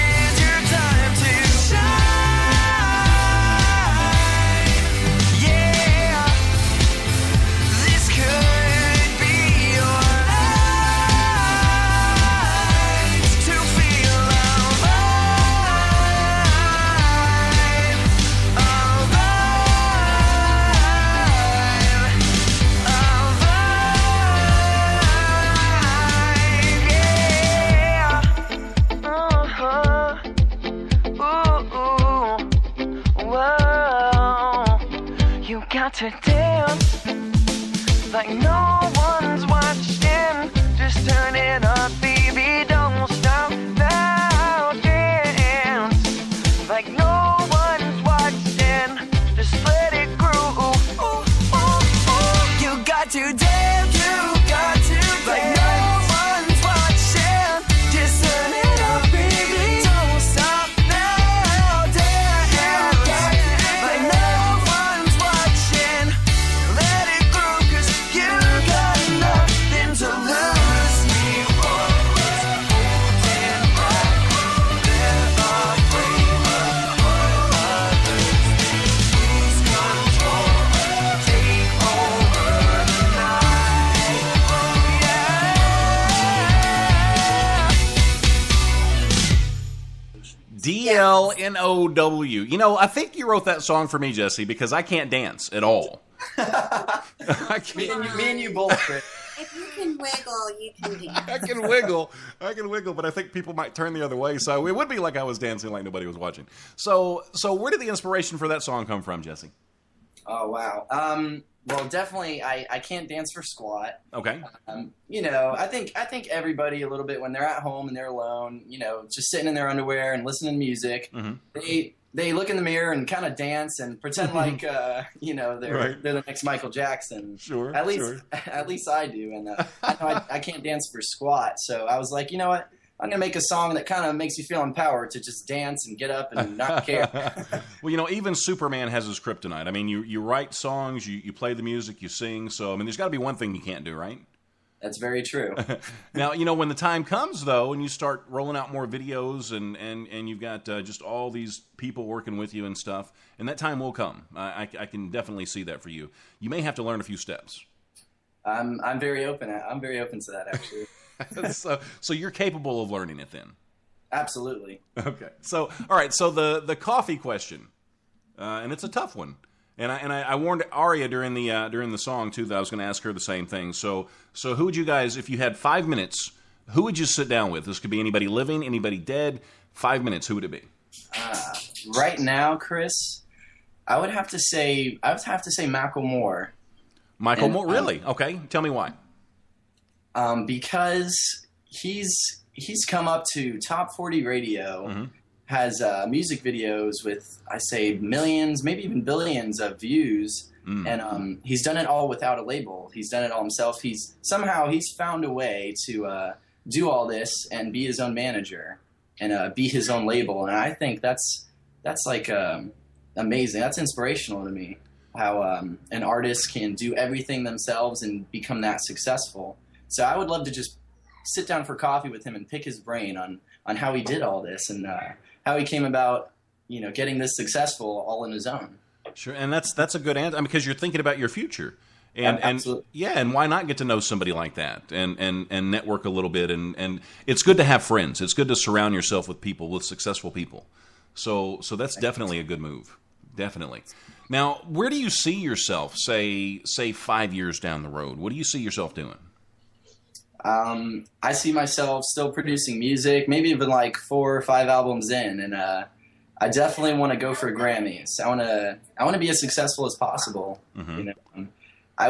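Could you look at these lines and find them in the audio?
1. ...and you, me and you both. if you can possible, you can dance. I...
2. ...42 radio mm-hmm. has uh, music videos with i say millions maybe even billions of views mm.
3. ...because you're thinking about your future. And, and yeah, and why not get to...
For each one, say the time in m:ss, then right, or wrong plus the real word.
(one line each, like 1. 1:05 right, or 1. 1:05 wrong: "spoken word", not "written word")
1. 1:37 wrong: "wiggle", not "possible"
2. 3:13 wrong: "40", not "42"
3. 3:50 right.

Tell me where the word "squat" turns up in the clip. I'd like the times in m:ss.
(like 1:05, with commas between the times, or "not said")
1:53, 2:10.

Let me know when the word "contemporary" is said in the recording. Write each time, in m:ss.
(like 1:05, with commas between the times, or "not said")
not said.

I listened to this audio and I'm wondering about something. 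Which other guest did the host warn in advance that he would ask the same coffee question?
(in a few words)
Aria.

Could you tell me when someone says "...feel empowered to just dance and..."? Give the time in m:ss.
2:14.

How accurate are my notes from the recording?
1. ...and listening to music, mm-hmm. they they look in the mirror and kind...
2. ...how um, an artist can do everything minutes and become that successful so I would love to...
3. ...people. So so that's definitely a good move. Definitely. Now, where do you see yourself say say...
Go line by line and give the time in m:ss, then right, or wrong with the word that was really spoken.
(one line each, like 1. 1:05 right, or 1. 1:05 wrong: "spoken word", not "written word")
1. 2:00 right
2. 3:35 wrong: "themselves", not "minutes"
3. 4:00 right.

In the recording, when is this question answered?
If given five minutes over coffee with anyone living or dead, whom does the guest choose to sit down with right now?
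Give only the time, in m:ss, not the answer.
3:05.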